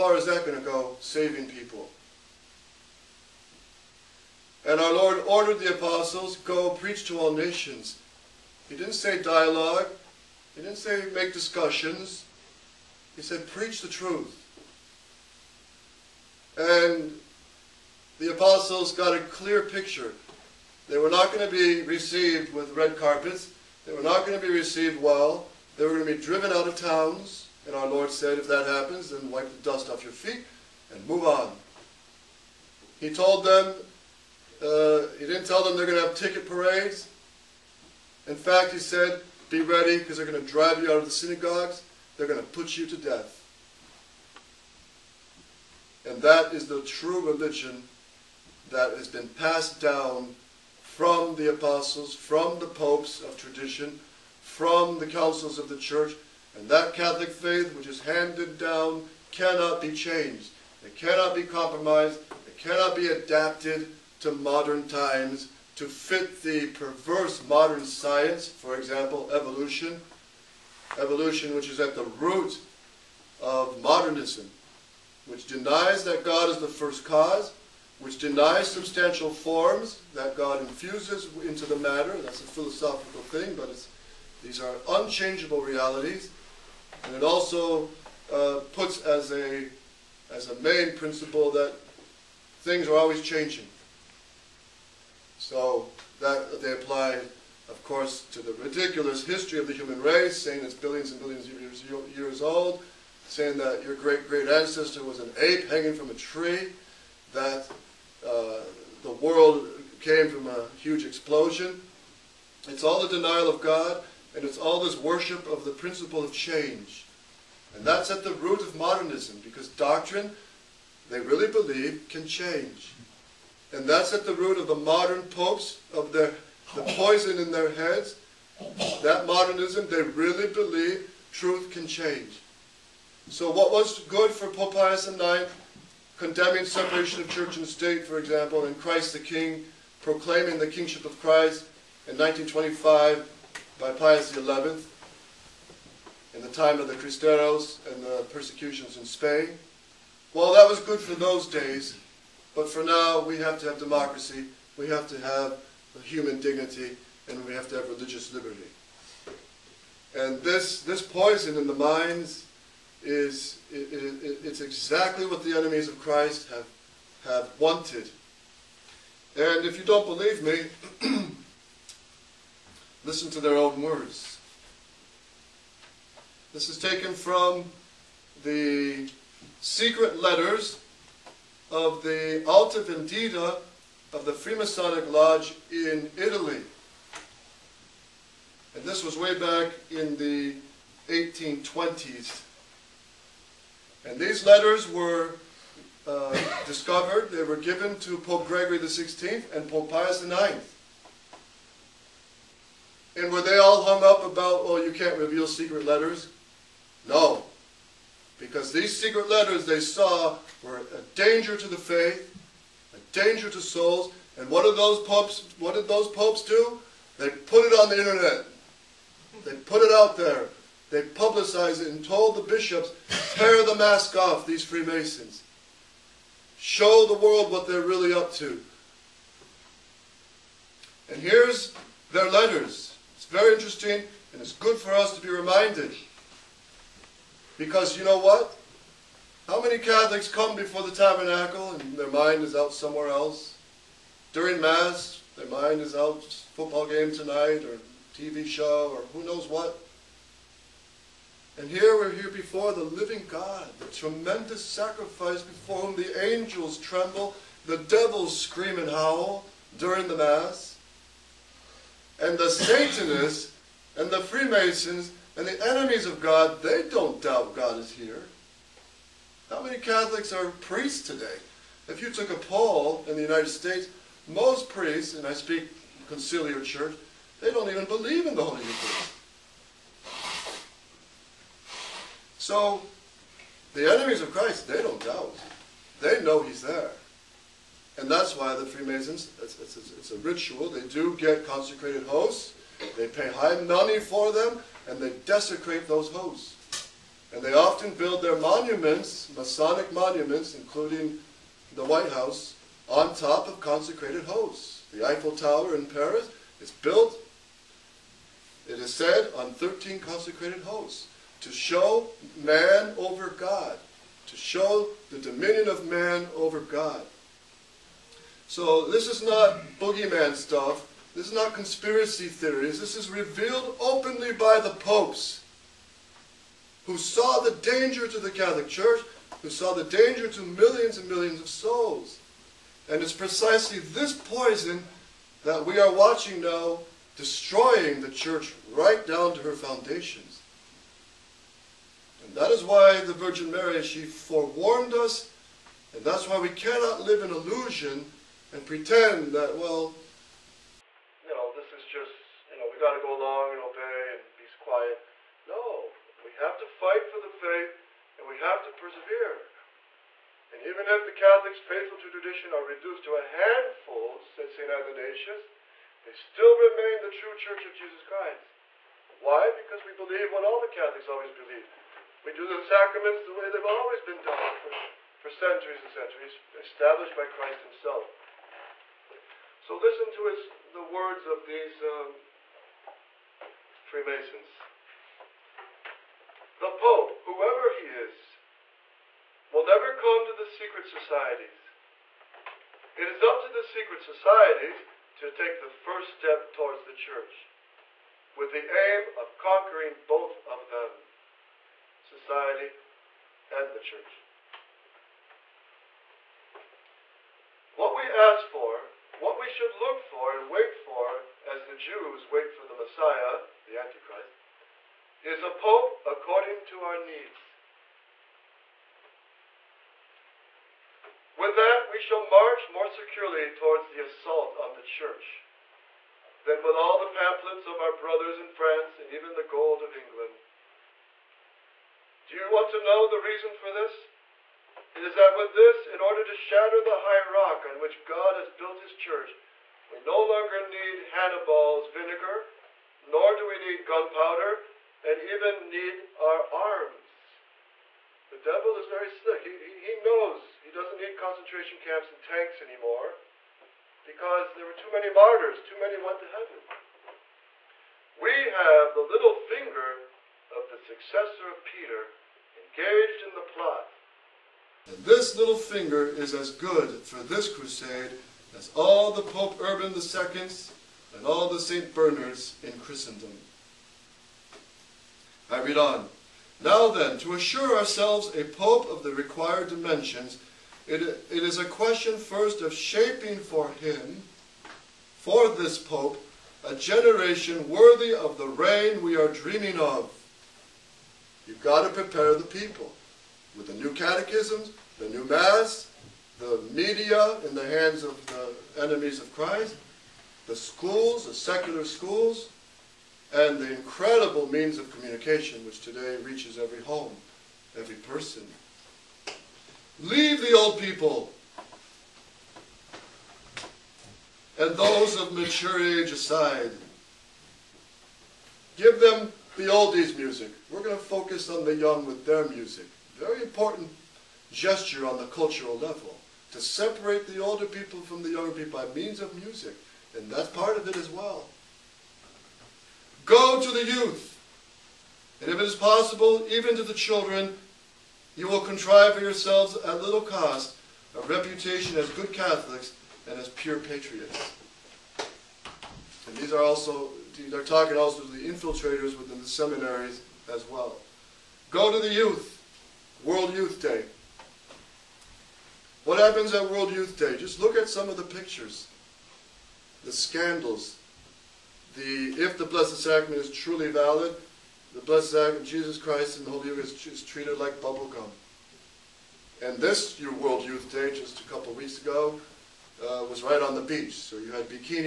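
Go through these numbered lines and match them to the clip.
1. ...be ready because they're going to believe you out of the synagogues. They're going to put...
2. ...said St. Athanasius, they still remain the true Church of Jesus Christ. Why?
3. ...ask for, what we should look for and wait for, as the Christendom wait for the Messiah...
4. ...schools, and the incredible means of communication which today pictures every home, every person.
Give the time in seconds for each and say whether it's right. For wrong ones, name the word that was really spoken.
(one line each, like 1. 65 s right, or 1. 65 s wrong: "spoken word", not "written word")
1. 39 s wrong: "drive", not "believe"
2. 364 s right
3. 408 s wrong: "Jews", not "Christendom"
4. 501 s wrong: "reaches", not "pictures".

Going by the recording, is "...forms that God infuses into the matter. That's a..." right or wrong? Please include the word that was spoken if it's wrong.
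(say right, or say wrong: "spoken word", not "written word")
right.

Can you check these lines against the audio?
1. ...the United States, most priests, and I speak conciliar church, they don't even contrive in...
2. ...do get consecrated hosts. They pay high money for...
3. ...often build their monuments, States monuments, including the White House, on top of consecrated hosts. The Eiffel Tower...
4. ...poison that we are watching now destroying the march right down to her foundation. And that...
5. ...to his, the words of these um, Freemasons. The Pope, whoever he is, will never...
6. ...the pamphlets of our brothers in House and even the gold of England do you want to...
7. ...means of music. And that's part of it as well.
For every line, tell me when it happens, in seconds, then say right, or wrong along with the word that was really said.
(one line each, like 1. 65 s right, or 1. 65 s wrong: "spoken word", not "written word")
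1. 273 s wrong: "believe", not "contrive"
2. 290 s right
3. 297 s wrong: "Masonic", not "States"
4. 334 s wrong: "church", not "march"
5. 380 s right
6. 426 s wrong: "France", not "House"
7. 528 s right.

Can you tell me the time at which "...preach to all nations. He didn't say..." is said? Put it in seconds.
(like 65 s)
6 s.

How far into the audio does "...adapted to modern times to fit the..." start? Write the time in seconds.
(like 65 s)
63 s.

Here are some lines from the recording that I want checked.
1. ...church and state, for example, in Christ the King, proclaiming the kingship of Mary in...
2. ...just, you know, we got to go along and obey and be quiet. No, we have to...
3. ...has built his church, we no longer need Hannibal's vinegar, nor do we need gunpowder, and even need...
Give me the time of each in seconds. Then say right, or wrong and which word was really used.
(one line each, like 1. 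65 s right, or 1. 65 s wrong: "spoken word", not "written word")
1. 137 s wrong: "Christ", not "Mary"
2. 351 s right
3. 438 s right.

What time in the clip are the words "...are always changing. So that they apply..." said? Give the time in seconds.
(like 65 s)
92 s.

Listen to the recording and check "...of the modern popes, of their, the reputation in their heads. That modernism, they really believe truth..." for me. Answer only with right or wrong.
wrong.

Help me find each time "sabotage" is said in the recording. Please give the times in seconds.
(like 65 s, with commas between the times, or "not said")
not said.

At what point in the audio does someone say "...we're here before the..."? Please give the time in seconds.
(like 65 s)
251 s.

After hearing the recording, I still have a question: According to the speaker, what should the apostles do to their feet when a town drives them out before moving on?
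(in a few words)
Wipe the dust off.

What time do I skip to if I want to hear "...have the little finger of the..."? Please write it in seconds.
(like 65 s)
458 s.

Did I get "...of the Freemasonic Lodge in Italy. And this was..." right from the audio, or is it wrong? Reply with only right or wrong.
right.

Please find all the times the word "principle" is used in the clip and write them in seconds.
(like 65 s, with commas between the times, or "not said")
90 s, 115 s.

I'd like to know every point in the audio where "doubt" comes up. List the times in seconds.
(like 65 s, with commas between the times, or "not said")
267 s, 285 s.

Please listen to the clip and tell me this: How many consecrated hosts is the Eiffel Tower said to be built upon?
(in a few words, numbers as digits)
13.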